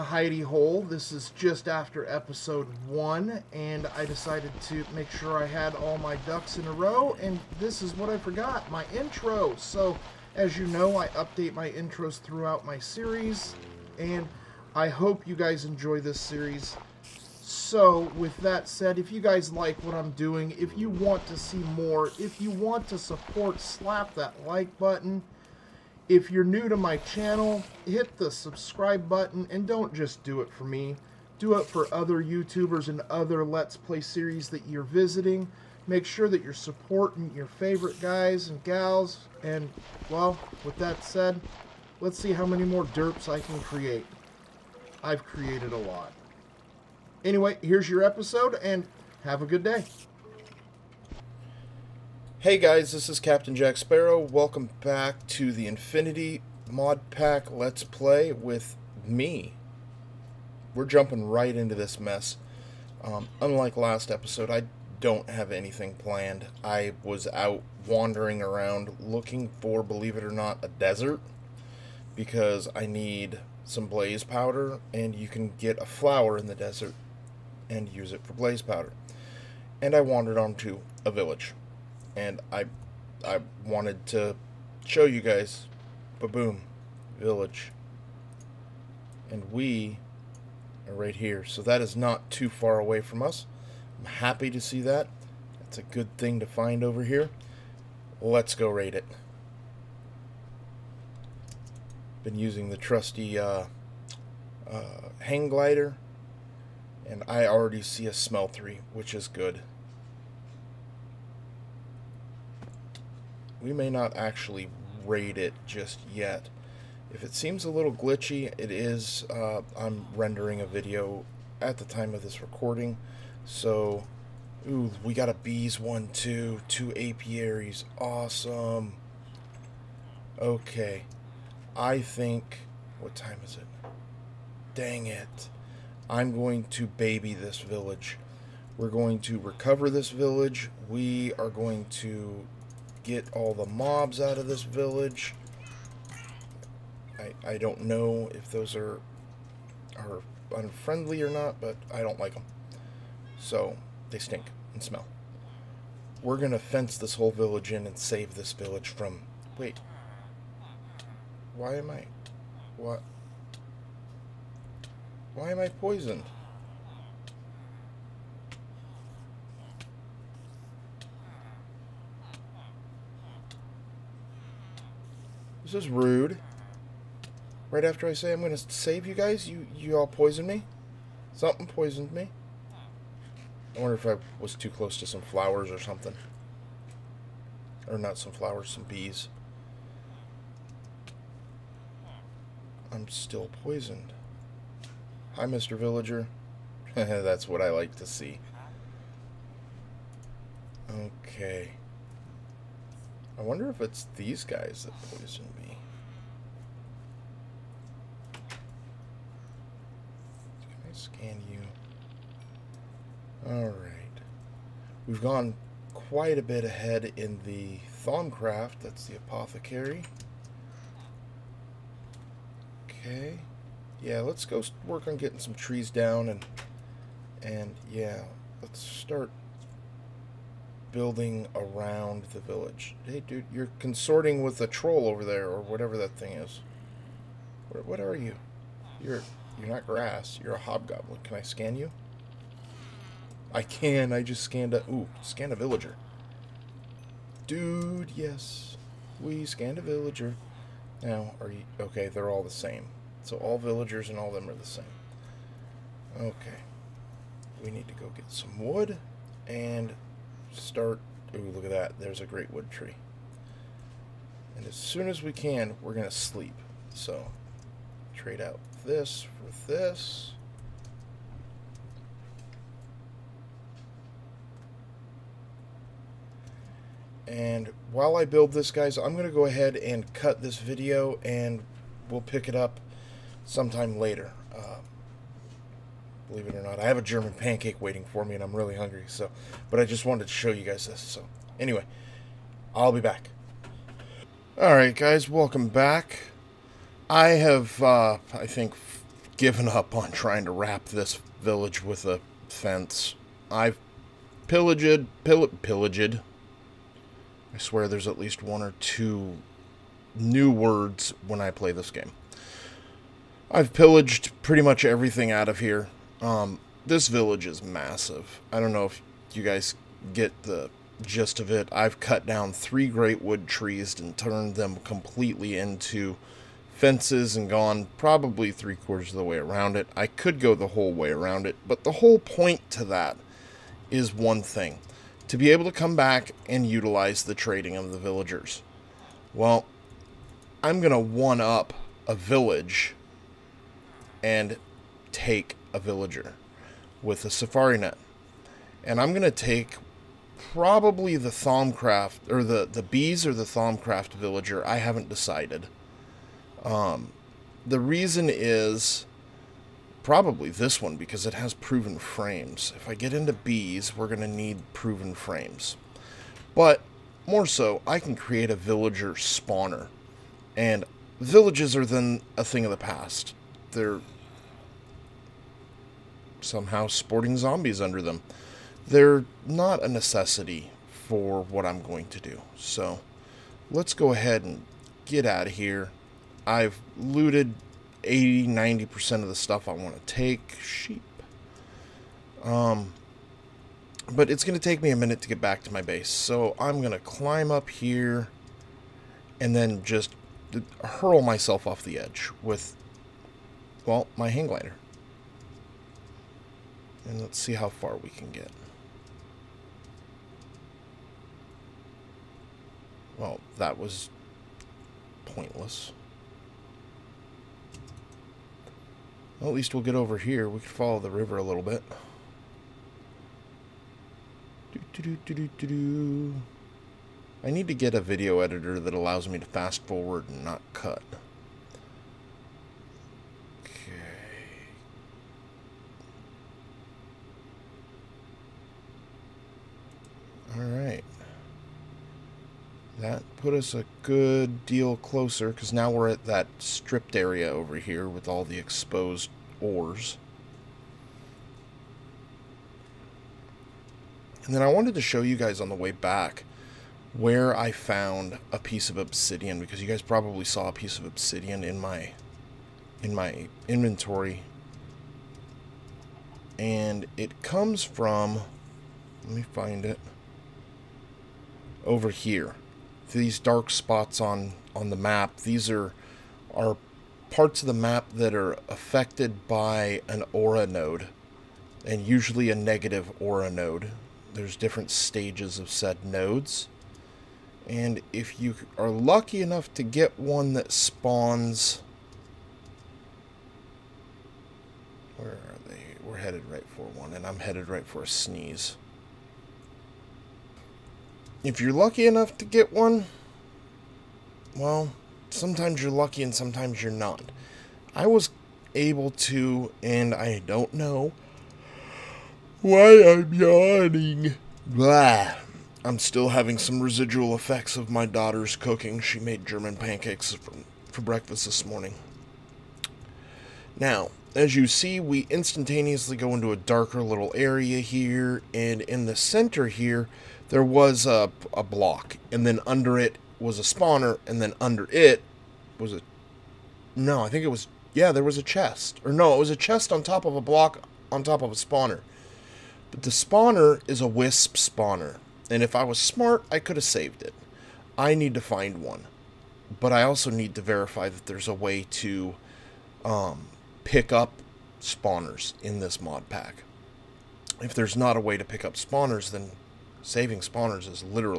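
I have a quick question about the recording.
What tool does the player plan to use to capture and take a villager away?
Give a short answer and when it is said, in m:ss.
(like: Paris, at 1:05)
safari net, at 5:47.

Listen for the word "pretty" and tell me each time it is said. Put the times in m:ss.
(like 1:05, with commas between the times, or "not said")
5:14.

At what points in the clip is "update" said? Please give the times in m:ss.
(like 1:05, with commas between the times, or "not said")
0:11.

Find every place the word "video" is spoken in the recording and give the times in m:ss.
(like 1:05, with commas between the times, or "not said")
2:00, 4:40, 7:07.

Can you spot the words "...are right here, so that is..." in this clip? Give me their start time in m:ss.
1:30.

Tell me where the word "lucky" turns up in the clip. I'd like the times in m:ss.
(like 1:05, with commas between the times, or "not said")
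8:08, 8:21, 8:25.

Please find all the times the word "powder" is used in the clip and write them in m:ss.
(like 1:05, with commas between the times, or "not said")
1:14, 1:18.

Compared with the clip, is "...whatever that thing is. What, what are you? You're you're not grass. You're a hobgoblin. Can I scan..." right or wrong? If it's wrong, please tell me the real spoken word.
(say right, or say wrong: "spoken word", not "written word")
right.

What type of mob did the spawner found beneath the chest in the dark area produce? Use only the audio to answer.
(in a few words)
wisp.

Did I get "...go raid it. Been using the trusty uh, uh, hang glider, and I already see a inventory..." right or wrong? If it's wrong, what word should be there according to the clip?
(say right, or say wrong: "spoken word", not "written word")
wrong: "smeltery", not "inventory".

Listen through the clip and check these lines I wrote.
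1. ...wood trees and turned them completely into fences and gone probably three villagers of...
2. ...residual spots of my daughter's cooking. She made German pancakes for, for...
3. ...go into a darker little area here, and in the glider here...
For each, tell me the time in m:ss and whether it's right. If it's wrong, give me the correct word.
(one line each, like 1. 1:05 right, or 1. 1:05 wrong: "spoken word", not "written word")
1. 5:23 wrong: "quarters", not "villagers"
2. 8:36 wrong: "effects", not "spots"
3. 8:46 wrong: "center", not "glider".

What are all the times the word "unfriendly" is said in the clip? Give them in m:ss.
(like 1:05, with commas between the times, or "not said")
2:30.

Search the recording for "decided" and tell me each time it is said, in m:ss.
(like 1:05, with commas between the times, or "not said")
0:04, 5:55.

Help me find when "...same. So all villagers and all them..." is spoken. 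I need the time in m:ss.
4:12.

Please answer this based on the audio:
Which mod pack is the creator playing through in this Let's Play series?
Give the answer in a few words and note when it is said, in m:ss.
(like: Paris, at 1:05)
Infinity, at 0:55.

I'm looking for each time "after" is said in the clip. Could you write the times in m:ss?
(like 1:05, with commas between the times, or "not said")
0:01, 2:57.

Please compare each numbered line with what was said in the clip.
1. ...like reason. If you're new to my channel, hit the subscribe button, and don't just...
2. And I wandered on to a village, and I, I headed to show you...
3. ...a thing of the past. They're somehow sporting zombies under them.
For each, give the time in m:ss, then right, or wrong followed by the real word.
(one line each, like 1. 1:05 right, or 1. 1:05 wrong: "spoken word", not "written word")
1. 0:24 wrong: "button", not "reason"
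2. 1:19 wrong: "wanted", not "headed"
3. 6:12 right.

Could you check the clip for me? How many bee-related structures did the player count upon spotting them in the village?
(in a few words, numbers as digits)
2.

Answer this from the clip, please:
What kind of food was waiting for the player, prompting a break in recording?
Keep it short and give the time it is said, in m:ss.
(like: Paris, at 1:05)
German pancake, at 4:47.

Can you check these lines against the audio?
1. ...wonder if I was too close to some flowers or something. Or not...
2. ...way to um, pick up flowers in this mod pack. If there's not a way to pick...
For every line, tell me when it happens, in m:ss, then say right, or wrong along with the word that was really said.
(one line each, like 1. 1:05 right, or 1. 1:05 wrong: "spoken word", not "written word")
1. 3:03 right
2. 9:11 wrong: "spawners", not "flowers".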